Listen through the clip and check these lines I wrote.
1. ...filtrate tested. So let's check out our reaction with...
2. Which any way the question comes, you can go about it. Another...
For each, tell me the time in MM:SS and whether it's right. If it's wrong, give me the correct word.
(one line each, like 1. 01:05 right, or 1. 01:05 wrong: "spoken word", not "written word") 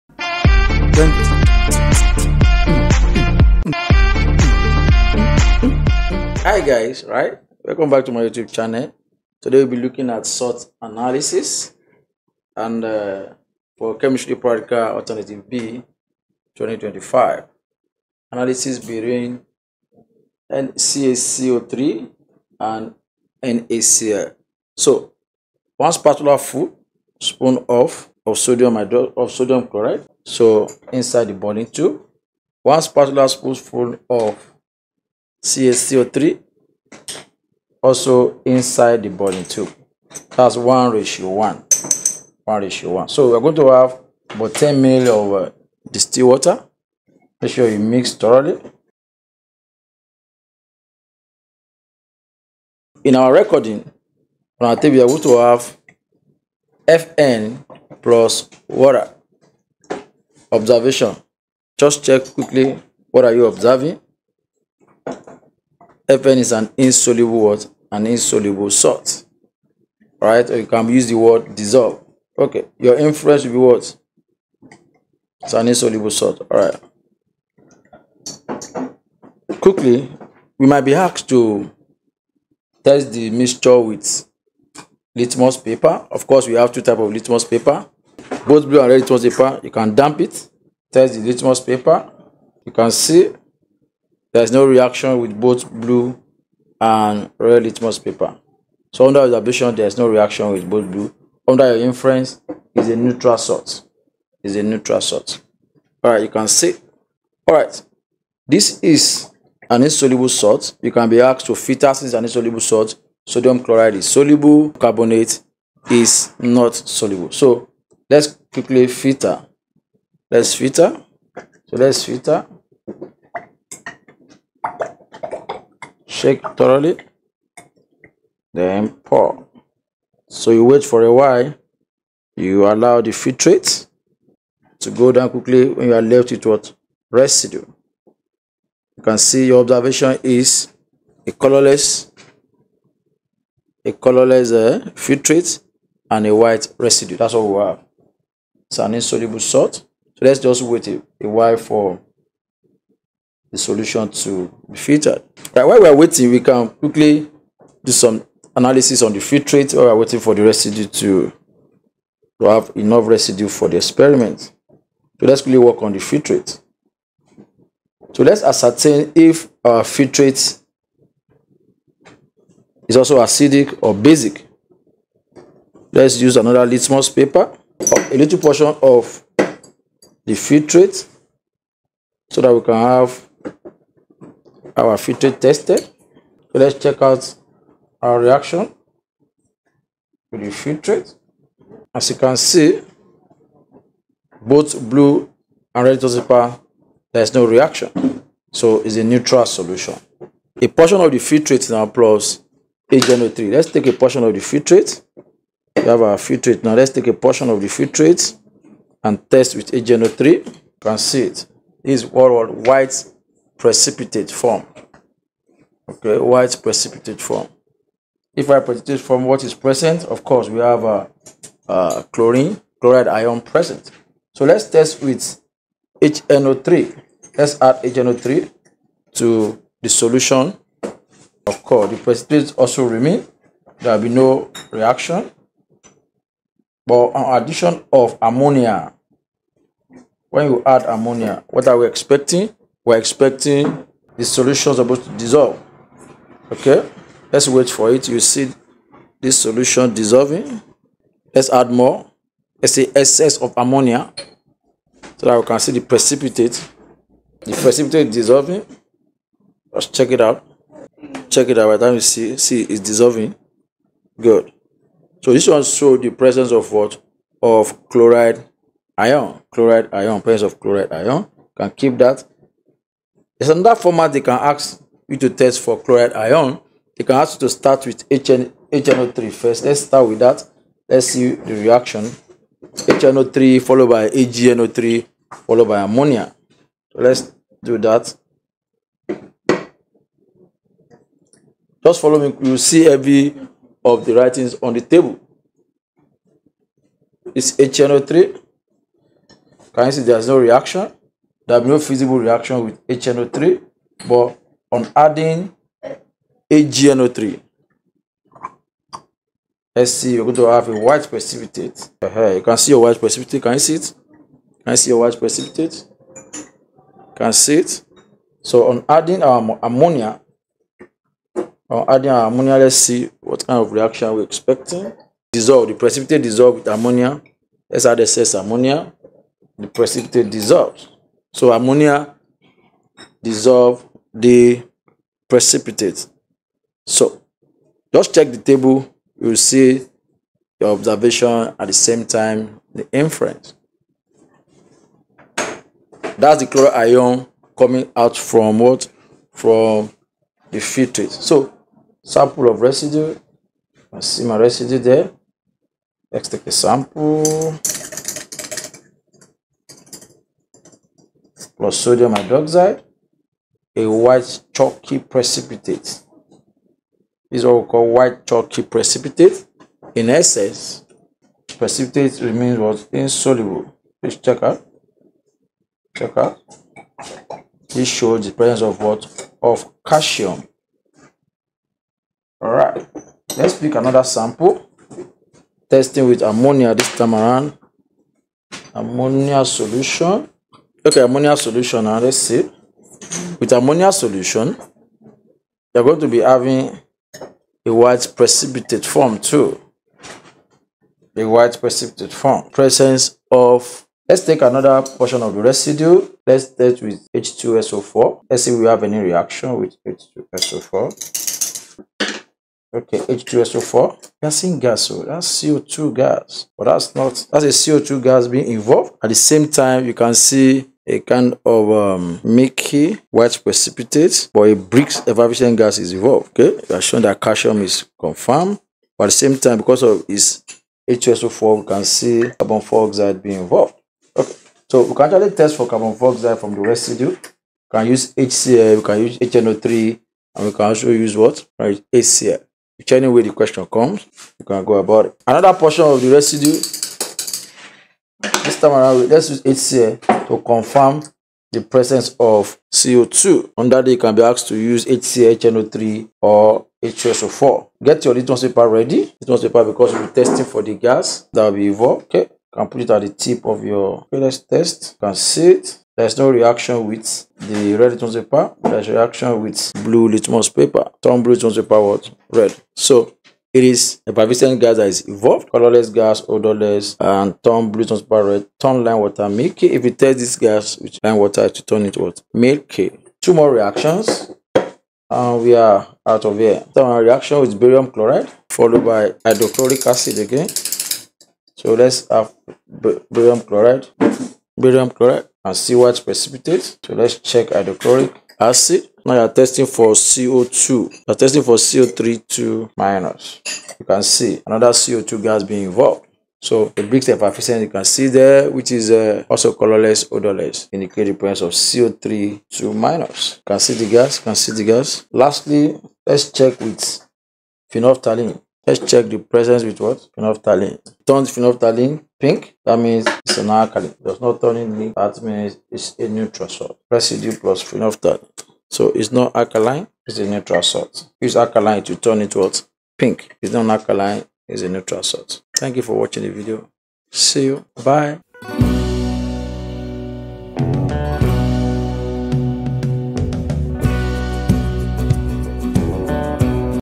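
1. 03:04 right
2. 07:22 right.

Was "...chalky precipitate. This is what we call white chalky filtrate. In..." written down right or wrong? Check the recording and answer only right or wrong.
wrong.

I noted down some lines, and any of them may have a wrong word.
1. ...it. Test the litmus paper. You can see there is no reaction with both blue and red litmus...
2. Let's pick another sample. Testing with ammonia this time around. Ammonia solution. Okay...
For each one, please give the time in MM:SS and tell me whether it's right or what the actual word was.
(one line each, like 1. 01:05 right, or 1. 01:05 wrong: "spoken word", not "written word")
1. 01:30 right
2. 06:23 right.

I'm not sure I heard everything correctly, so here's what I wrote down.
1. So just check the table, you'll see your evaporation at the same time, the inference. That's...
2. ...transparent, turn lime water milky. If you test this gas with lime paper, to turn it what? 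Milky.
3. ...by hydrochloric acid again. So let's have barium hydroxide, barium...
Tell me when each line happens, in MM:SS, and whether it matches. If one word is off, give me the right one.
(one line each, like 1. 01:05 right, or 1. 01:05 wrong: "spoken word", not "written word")
1. 05:36 wrong: "observation", not "evaporation"
2. 07:57 wrong: "water", not "paper"
3. 08:08 wrong: "chloride", not "hydroxide".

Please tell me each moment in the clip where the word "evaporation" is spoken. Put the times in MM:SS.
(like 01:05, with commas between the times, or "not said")
07:05.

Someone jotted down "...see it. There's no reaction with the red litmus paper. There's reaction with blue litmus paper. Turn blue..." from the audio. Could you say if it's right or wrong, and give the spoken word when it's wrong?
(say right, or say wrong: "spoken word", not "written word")
right.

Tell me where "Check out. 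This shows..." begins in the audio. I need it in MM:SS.
06:15.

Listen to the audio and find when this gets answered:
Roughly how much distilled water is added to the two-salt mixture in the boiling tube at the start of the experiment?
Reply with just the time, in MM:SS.
00:44.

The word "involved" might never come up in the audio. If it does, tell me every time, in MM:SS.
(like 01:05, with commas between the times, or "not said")
06:58, 07:13, 07:41, 08:25.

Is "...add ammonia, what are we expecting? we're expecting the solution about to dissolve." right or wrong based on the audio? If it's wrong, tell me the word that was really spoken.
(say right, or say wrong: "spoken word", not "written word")
right.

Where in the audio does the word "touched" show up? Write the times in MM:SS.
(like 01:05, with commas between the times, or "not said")
not said.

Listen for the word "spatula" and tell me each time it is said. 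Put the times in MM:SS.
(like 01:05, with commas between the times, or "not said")
00:25, 00:32.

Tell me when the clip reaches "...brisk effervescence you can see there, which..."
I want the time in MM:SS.
08:26.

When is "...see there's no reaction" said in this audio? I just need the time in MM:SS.
04:59.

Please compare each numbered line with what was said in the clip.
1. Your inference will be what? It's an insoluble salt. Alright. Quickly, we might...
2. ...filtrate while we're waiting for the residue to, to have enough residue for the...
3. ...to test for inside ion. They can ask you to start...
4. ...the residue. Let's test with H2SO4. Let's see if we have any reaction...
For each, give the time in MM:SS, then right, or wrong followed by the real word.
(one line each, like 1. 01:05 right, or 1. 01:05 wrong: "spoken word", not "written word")
1. 01:12 right
2. 02:39 right
3. 04:35 wrong: "chloride", not "inside"
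4. 06:45 right.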